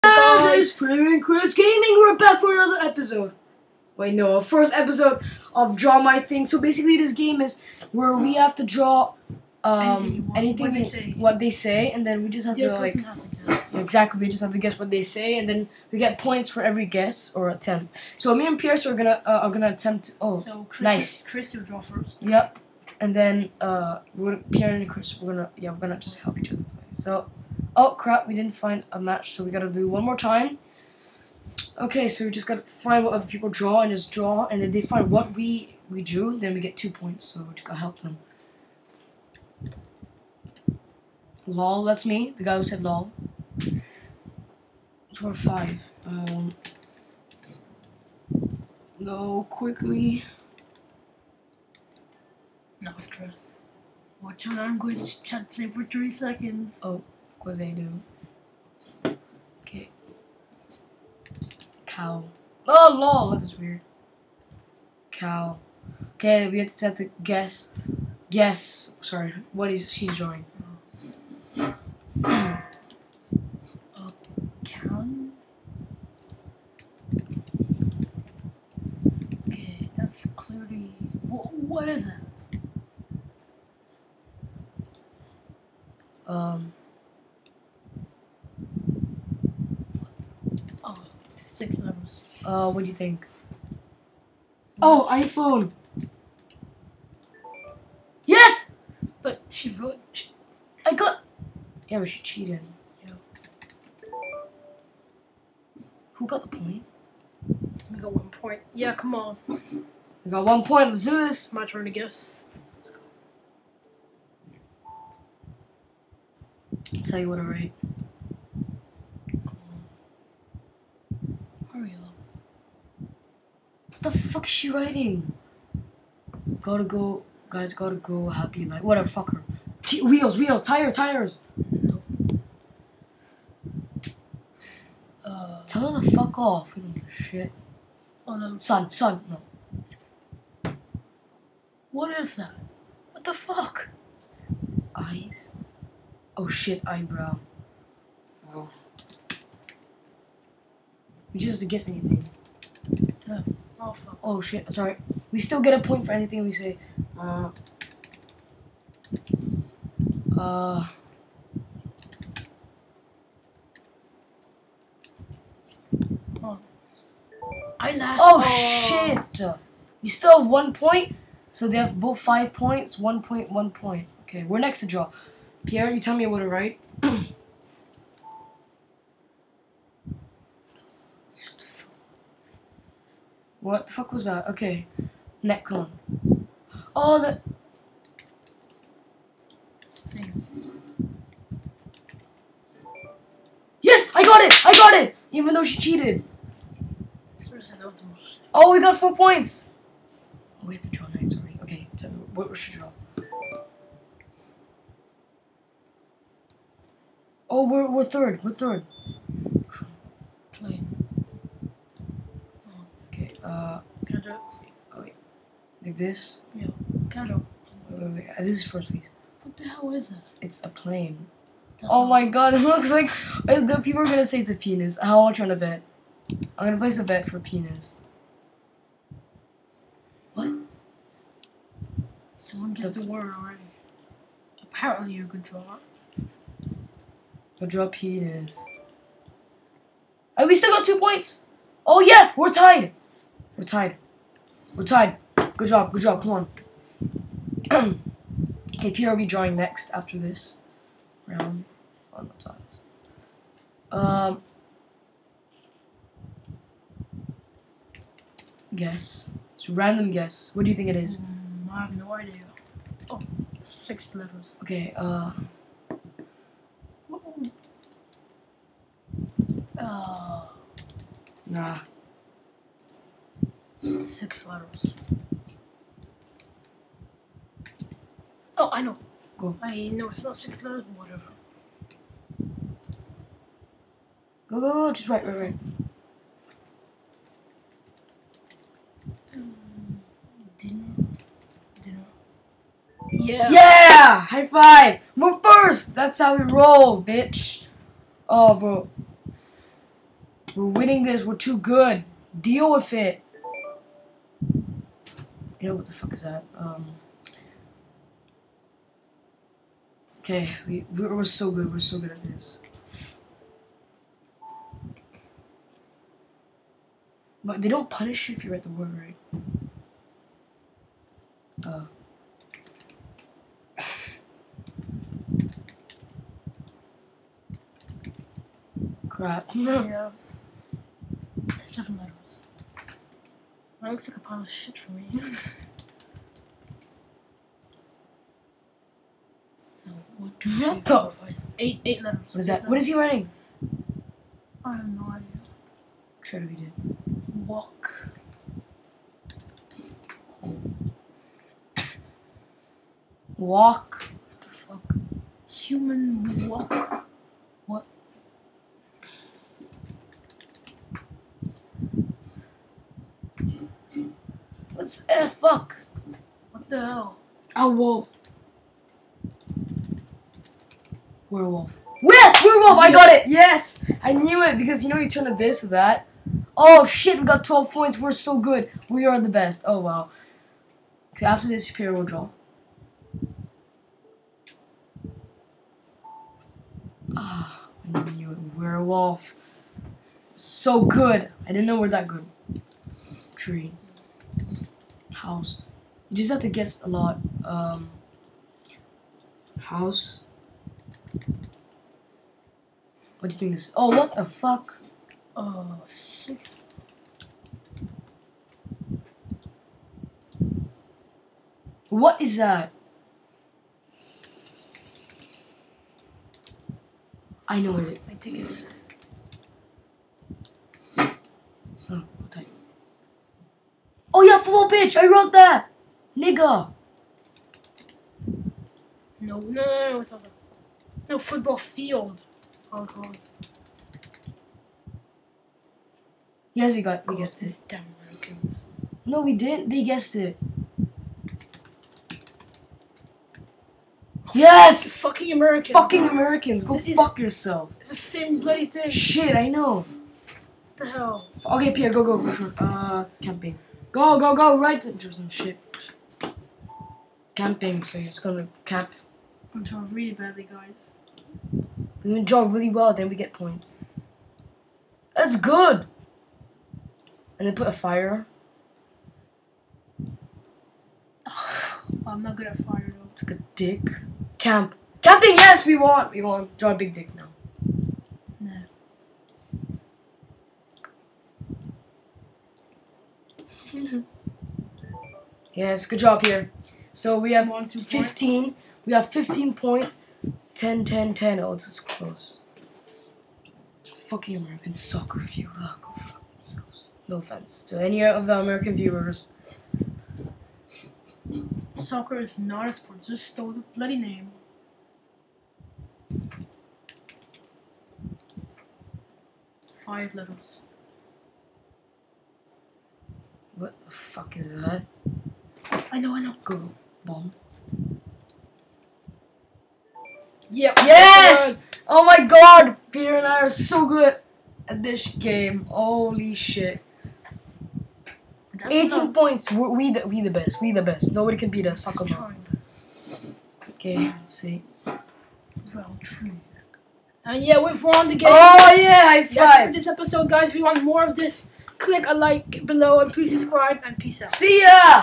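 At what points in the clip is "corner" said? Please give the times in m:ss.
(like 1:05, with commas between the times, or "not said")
not said.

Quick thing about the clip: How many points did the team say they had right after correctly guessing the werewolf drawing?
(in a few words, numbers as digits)
12.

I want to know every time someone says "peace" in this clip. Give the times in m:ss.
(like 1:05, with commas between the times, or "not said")
9:03.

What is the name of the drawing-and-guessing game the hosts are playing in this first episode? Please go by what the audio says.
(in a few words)
Draw My Thing.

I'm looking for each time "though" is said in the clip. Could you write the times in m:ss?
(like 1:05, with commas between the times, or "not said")
3:15, 7:52.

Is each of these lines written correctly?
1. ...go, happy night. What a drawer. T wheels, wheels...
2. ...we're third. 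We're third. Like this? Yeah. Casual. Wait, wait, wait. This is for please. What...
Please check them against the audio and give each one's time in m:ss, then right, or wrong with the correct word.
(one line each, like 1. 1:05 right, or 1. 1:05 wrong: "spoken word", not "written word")
1. 2:07 wrong: "fucker", not "drawer"
2. 3:27 right.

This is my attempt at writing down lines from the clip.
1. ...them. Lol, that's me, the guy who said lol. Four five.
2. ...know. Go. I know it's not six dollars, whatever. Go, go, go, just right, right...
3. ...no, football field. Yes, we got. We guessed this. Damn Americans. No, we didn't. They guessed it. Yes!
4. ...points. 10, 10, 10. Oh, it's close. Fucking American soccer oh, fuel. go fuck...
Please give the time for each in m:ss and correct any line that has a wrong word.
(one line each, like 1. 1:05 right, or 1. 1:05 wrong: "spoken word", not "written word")
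1. 0:38 right
2. 4:38 right
3. 7:11 right
4. 8:09 right.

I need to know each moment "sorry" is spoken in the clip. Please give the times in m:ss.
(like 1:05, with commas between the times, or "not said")
1:09, 2:34.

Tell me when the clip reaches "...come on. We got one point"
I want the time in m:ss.
1:48.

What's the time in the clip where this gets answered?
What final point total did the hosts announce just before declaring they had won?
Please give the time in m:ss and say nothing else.
8:48.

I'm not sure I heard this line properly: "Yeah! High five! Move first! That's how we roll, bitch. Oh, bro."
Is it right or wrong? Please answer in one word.
right.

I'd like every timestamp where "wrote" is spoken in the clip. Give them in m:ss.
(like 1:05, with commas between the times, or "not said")
1:39, 7:05.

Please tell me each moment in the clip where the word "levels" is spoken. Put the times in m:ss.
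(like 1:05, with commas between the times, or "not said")
1:31, 4:24, 8:30.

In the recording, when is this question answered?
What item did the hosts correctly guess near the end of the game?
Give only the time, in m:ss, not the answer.
8:37.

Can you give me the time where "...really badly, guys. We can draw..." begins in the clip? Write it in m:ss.
7:39.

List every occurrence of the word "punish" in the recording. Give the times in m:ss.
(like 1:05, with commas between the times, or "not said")
5:17.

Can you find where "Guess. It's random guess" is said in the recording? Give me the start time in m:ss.
4:18.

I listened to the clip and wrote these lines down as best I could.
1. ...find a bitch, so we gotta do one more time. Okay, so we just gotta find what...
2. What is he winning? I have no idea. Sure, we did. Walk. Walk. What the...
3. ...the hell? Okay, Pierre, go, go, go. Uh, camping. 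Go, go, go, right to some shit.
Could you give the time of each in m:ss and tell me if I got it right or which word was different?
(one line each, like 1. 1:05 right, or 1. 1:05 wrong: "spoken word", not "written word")
1. 0:28 wrong: "match", not "bitch"
2. 5:42 wrong: "writing", not "winning"
3. 7:30 right.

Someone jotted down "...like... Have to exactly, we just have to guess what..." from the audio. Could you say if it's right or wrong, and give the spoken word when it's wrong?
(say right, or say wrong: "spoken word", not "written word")
right.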